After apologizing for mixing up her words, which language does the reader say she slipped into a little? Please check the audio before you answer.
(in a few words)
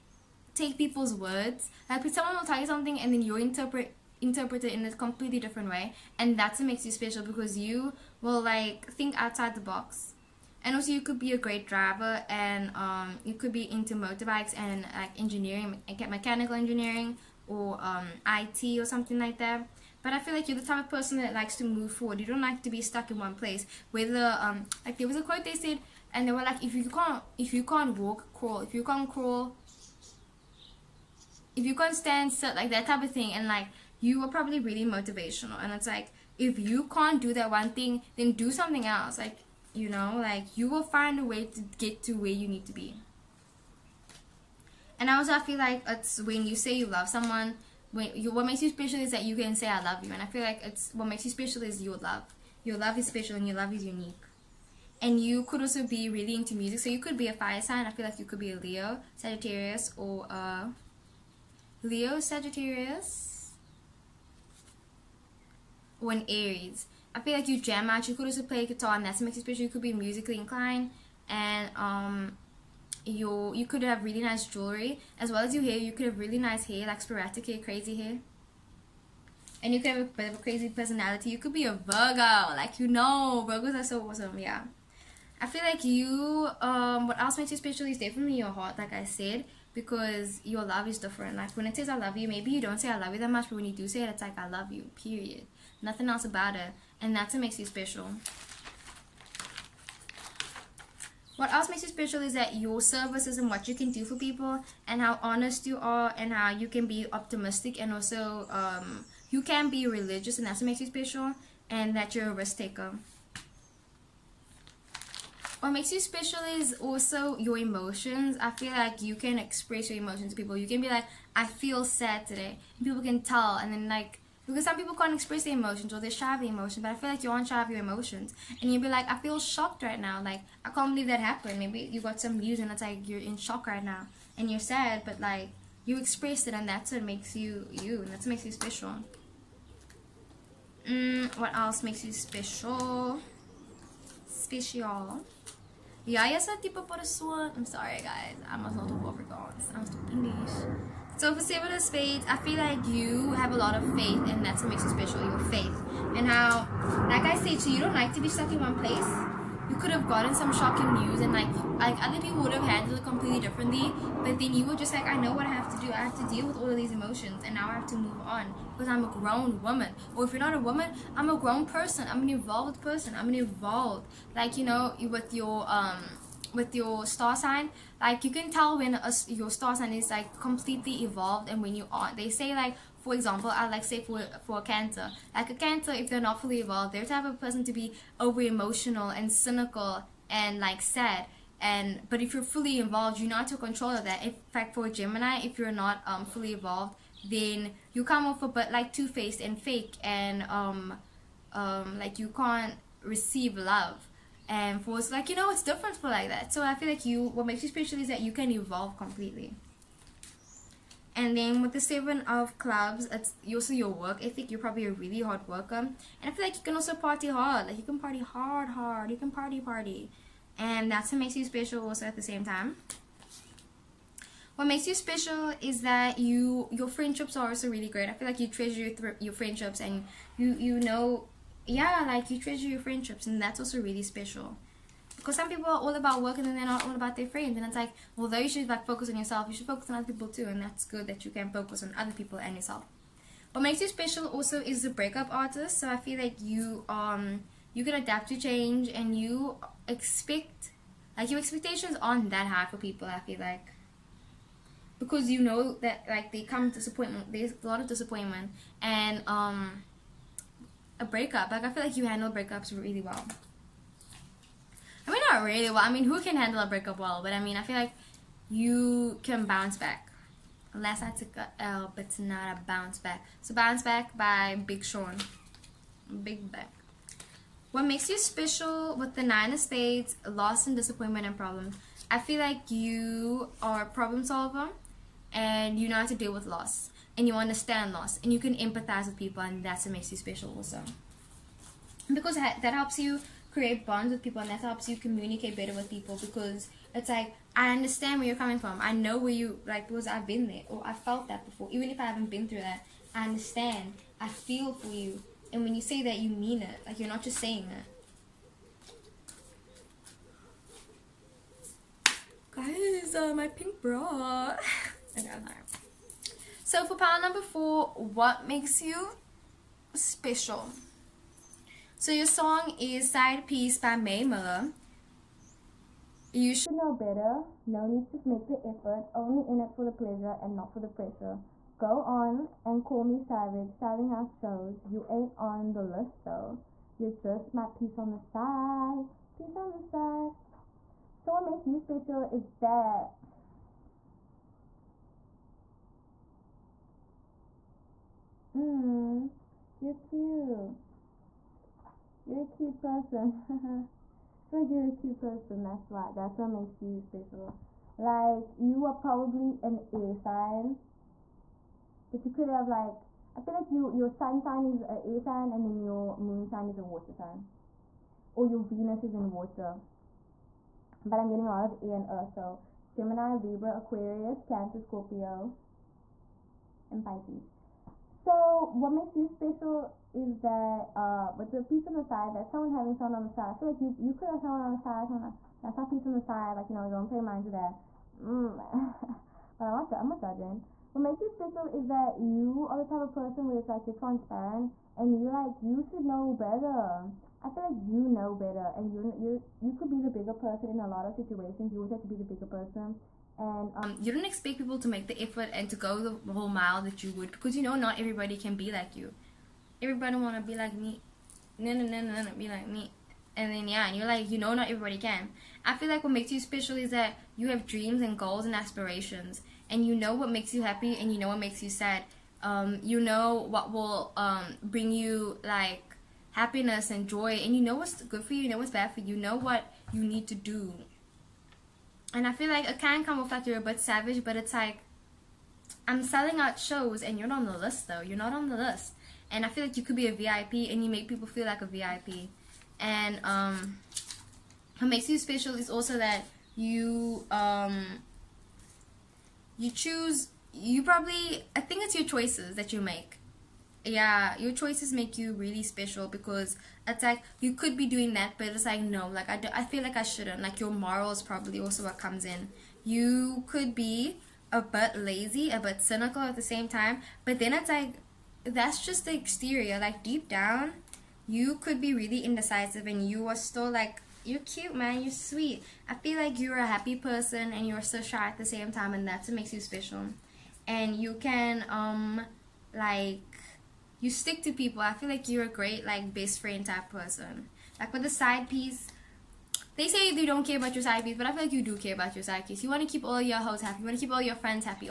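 Afrikaans.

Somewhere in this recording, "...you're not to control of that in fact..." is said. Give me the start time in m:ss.
3:13.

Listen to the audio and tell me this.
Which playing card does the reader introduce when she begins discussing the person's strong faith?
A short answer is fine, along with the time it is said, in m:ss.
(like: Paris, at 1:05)
Seven of Spades, at 2:31.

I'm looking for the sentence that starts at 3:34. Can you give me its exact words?
You're probably a really hard worker.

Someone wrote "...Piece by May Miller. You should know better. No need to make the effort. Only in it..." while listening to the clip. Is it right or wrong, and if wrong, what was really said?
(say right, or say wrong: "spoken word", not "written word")
right.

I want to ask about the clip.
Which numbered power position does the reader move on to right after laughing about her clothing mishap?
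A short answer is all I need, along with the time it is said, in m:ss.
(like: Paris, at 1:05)
power number 4, at 5:16.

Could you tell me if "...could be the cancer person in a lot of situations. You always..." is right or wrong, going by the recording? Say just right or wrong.
wrong.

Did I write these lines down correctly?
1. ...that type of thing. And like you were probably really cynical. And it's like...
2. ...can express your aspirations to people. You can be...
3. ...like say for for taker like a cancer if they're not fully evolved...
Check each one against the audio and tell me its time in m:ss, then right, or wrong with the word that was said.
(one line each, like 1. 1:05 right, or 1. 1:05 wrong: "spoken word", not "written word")
1. 0:32 wrong: "motivational", not "cynical"
2. 1:59 wrong: "emotions", not "aspirations"
3. 3:03 wrong: "cancer", not "taker".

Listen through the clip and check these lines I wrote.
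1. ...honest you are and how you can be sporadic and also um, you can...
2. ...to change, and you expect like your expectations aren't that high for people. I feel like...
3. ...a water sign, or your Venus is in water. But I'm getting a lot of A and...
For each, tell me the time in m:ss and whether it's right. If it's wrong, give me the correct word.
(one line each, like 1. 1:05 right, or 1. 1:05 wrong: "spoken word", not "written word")
1. 1:45 wrong: "optimistic", not "sporadic"
2. 4:08 right
3. 6:06 right.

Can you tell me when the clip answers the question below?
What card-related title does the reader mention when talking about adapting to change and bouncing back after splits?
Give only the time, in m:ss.
4:04.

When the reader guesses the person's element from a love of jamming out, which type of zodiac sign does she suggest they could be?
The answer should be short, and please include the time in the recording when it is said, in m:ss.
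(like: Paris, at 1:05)
fire sign, at 0:57.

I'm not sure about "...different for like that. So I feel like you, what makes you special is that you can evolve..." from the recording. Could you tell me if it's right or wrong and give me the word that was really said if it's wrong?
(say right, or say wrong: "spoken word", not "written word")
right.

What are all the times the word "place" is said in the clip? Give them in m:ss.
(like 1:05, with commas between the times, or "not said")
0:23, 2:38.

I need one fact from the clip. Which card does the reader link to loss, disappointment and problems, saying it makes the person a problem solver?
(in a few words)
nine of spades.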